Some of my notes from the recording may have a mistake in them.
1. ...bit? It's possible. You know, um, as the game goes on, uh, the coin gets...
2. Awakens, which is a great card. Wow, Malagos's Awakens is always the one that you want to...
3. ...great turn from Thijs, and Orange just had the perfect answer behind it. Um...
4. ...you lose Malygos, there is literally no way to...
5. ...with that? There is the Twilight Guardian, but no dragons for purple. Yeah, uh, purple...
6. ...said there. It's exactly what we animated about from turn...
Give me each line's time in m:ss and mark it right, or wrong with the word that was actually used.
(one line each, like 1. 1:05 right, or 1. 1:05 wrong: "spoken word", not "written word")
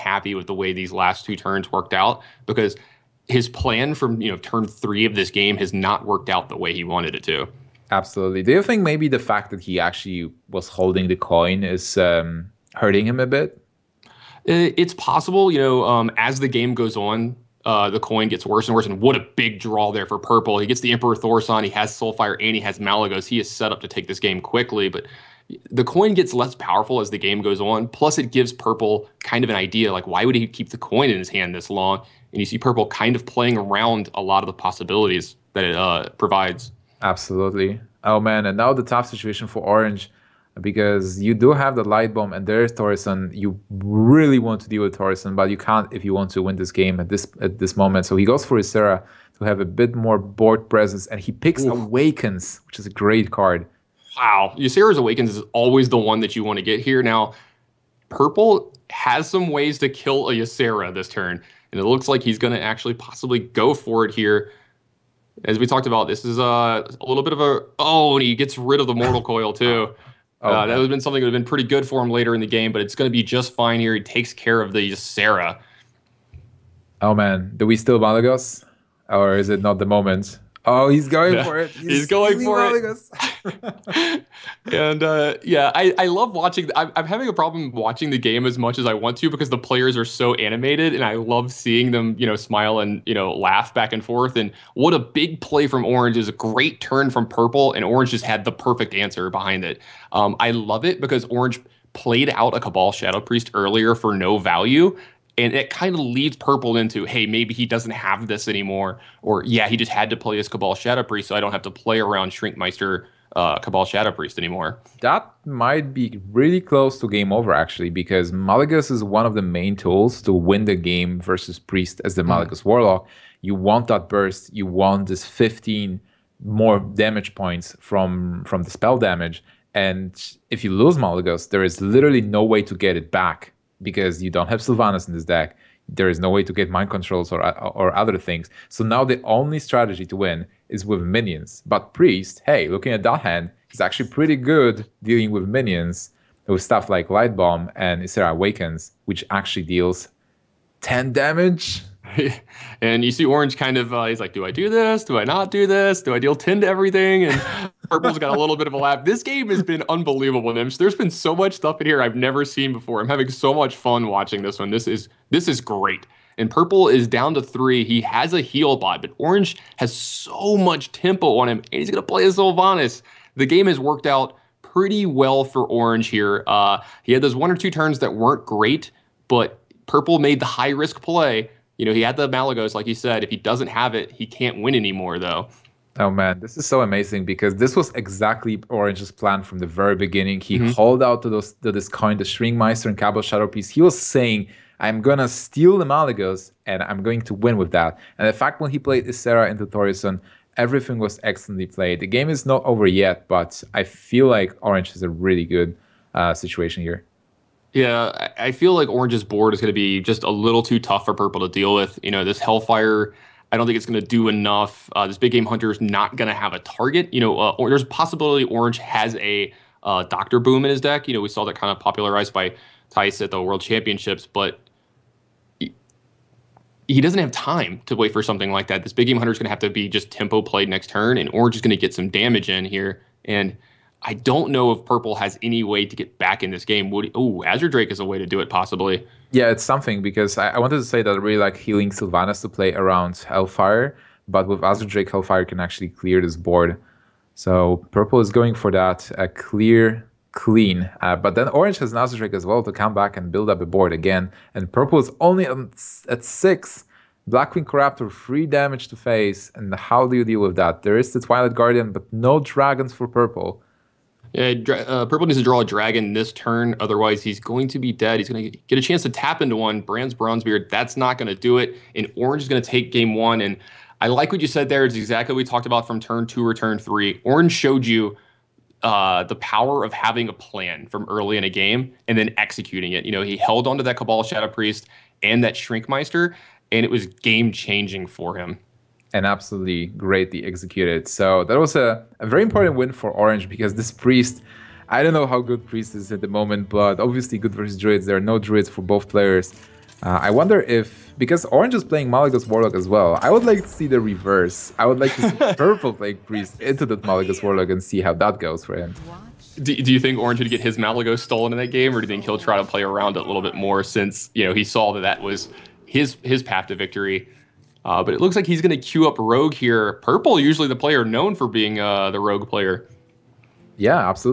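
1. 0:13 right
2. 0:51 wrong: "Ysera", not "Malagos"
3. 1:36 wrong: "Purple", not "Thijs"
4. 2:10 right
5. 4:20 right
6. 4:34 wrong: "talked", not "animated".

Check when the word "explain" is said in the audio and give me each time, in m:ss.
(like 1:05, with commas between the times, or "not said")
not said.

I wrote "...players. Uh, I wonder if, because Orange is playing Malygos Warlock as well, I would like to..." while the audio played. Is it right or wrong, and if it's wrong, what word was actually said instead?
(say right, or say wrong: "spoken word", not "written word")
right.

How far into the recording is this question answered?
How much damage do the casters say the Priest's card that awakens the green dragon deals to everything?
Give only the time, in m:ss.
2:30.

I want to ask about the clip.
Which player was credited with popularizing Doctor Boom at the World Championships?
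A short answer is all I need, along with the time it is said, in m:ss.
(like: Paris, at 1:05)
Thijs, at 3:42.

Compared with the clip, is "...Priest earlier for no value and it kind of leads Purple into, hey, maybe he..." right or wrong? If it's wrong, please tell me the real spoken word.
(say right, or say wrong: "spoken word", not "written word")
right.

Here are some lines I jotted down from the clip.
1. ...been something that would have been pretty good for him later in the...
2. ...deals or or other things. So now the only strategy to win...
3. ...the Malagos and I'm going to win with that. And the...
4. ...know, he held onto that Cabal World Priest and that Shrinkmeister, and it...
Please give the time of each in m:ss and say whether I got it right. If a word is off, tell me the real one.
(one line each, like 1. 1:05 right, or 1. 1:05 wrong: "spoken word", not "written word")
1. 1:10 right
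2. 2:16 wrong: "controls", not "deals"
3. 3:15 right
4. 4:43 wrong: "Shadow", not "World".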